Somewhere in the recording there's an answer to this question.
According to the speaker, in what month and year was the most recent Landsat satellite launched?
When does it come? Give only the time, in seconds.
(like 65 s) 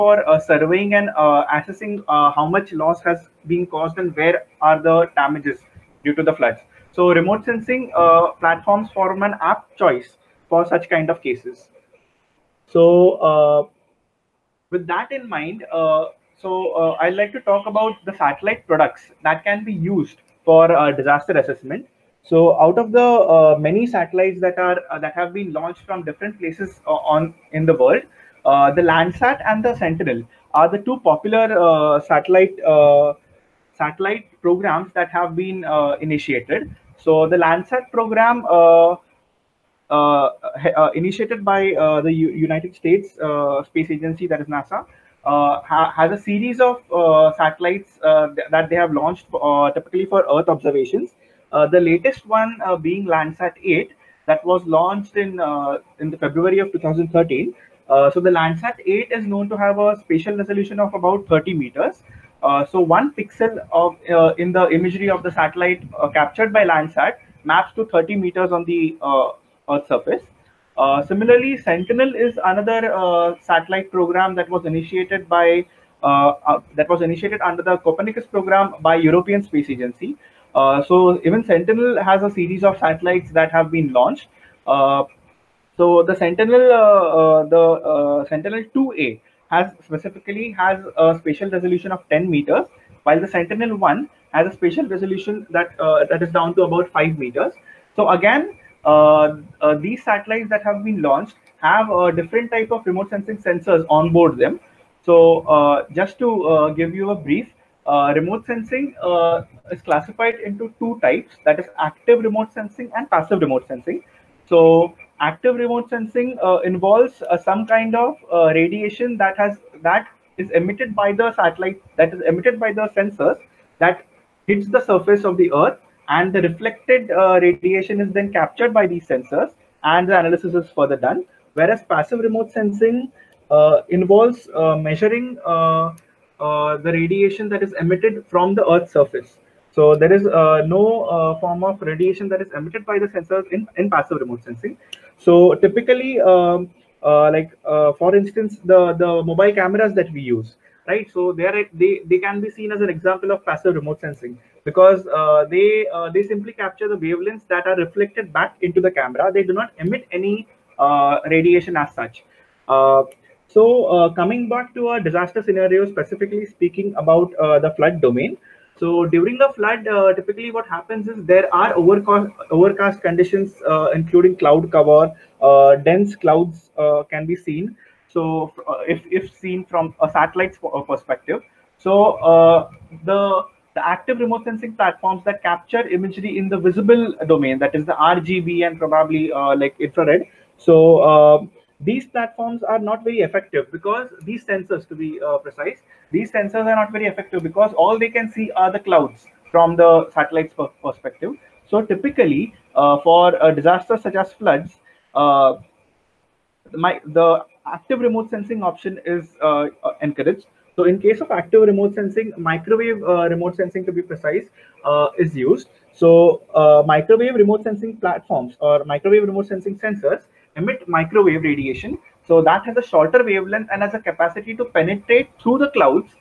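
56 s.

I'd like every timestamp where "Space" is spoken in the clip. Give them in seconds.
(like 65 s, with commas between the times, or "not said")
43 s, 79 s.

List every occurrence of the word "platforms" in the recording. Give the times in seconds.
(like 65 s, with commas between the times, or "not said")
8 s, 184 s, 192 s, 217 s.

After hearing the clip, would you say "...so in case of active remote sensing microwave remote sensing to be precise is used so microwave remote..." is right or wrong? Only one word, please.
right.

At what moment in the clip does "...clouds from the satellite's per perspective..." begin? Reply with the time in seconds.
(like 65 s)
198 s.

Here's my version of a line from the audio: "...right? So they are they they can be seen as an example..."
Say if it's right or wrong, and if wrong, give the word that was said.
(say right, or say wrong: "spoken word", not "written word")
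right.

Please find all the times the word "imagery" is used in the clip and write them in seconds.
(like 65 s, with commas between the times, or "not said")
64 s, 185 s.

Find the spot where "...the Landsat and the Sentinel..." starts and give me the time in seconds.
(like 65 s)
28 s.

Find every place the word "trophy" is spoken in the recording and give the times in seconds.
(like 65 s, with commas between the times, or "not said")
not said.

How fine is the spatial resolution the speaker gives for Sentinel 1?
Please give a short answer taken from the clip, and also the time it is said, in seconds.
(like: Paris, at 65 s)
5 meters, at 96 s.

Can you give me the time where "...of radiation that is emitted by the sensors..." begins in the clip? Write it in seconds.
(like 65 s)
141 s.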